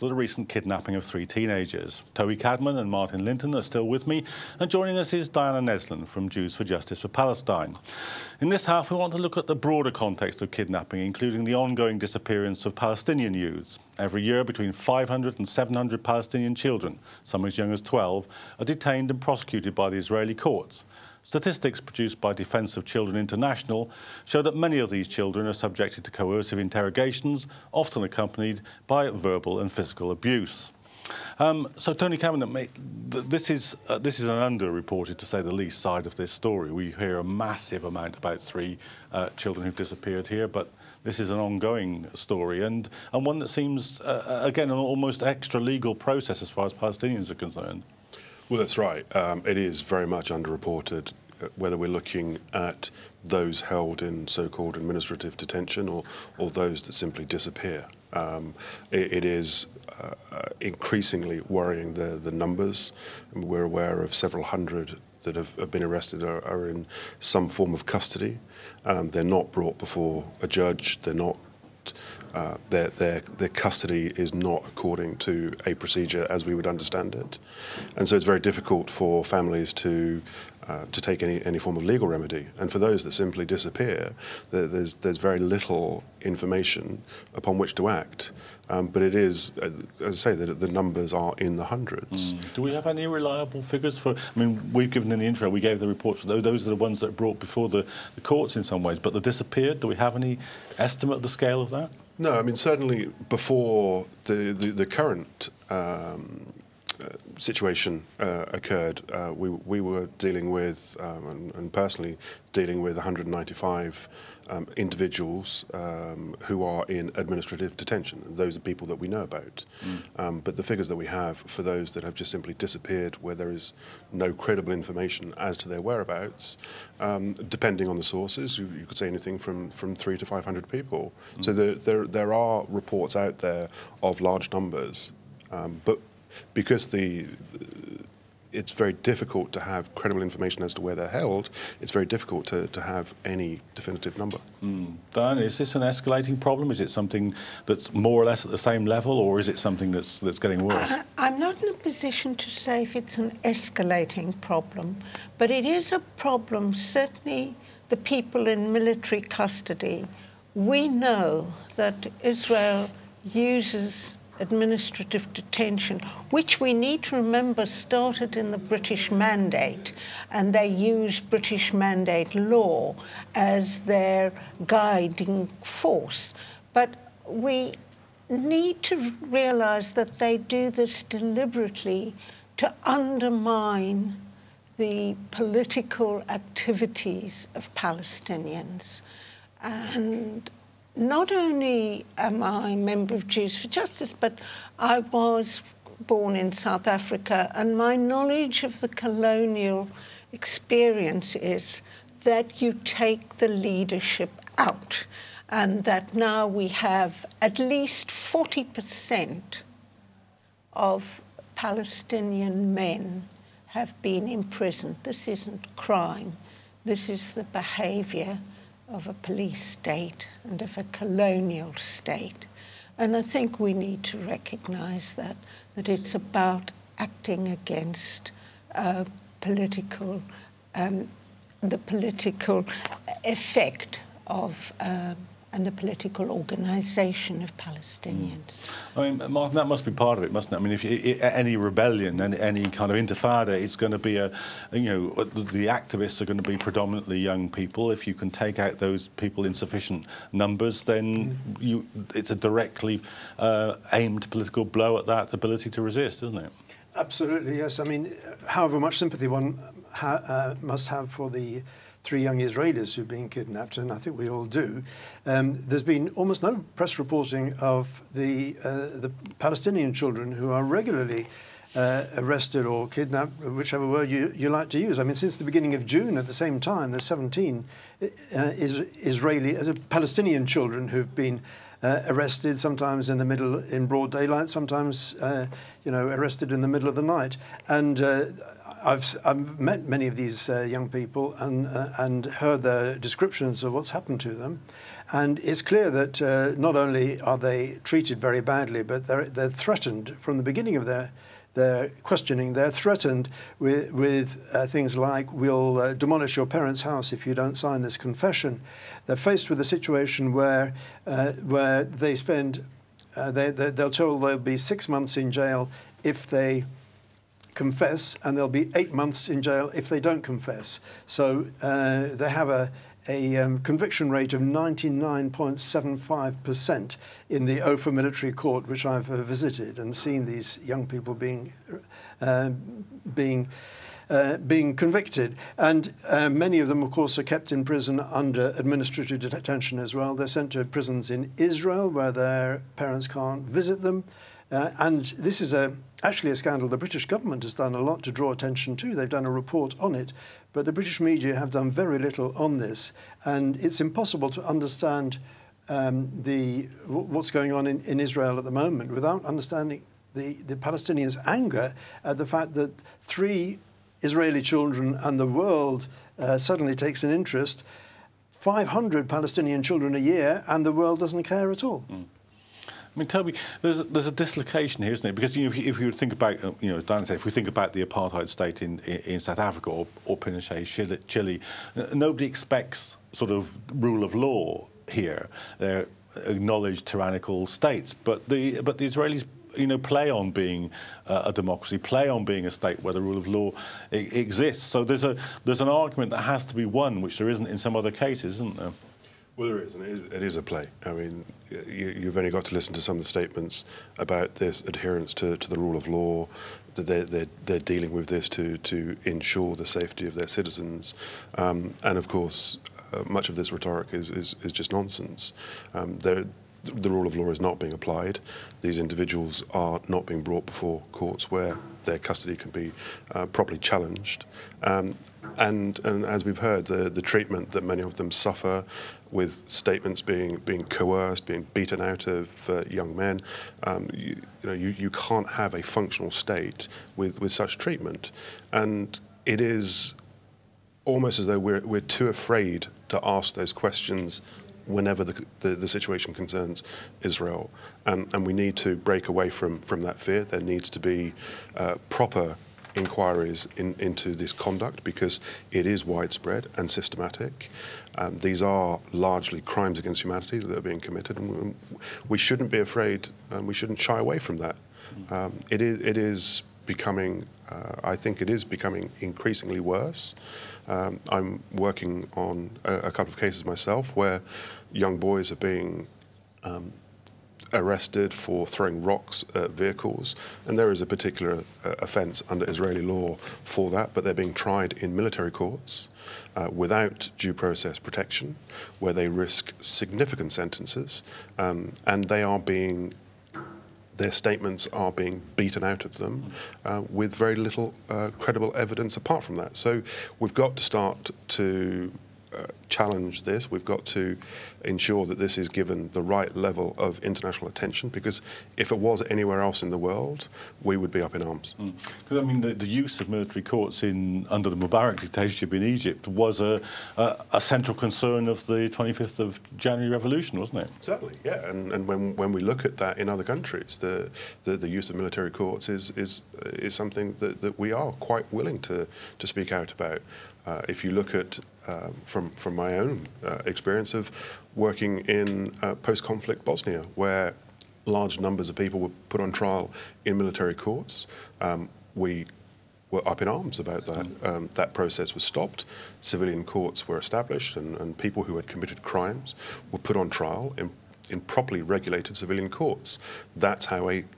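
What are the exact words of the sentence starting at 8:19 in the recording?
So we've got to start to uh, challenge this.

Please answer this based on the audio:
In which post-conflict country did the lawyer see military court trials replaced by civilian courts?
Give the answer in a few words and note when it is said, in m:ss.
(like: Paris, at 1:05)
Bosnia, at 8:56.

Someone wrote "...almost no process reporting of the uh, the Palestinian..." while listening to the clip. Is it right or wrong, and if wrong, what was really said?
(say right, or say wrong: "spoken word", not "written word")
wrong: "press", not "process".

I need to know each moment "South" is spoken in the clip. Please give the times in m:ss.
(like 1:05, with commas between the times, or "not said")
3:16, 6:19.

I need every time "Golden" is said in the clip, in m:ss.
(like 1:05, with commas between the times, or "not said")
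not said.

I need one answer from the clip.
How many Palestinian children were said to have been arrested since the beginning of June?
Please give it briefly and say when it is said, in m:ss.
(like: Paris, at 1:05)
17, at 4:37.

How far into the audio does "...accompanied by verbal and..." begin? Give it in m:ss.
0:28.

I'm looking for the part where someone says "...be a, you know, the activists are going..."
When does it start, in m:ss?
4:03.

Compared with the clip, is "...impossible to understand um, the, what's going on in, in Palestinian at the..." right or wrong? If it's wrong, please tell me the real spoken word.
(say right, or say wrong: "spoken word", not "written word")
wrong: "Israel", not "Palestinian".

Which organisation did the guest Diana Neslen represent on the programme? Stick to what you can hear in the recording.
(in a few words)
Jews for Justice for Palestine.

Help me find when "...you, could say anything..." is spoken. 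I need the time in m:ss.
2:08.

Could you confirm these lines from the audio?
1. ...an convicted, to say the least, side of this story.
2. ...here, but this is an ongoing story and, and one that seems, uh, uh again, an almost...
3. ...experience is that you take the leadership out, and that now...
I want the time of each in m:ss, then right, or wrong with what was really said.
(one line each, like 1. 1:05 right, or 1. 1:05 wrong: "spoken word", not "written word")
1. 0:34 wrong: "underreported", not "convicted"
2. 0:40 right
3. 3:20 right.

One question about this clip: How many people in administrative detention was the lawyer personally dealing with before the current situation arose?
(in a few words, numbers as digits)
195.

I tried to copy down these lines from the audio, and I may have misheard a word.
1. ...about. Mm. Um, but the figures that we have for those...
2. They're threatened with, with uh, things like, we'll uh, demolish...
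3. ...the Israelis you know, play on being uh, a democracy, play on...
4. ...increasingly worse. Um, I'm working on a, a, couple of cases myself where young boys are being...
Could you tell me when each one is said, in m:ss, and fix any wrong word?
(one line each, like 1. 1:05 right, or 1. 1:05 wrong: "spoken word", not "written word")
1. 1:59 right
2. 5:02 right
3. 6:28 right
4. 7:49 right.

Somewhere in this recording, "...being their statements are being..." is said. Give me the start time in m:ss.
8:12.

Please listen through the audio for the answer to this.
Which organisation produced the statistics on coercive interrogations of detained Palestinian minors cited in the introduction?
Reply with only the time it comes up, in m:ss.
0:22.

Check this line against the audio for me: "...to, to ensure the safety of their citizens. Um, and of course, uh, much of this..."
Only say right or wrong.
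right.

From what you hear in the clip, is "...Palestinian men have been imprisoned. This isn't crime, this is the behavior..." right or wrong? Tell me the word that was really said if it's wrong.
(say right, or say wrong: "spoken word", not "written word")
right.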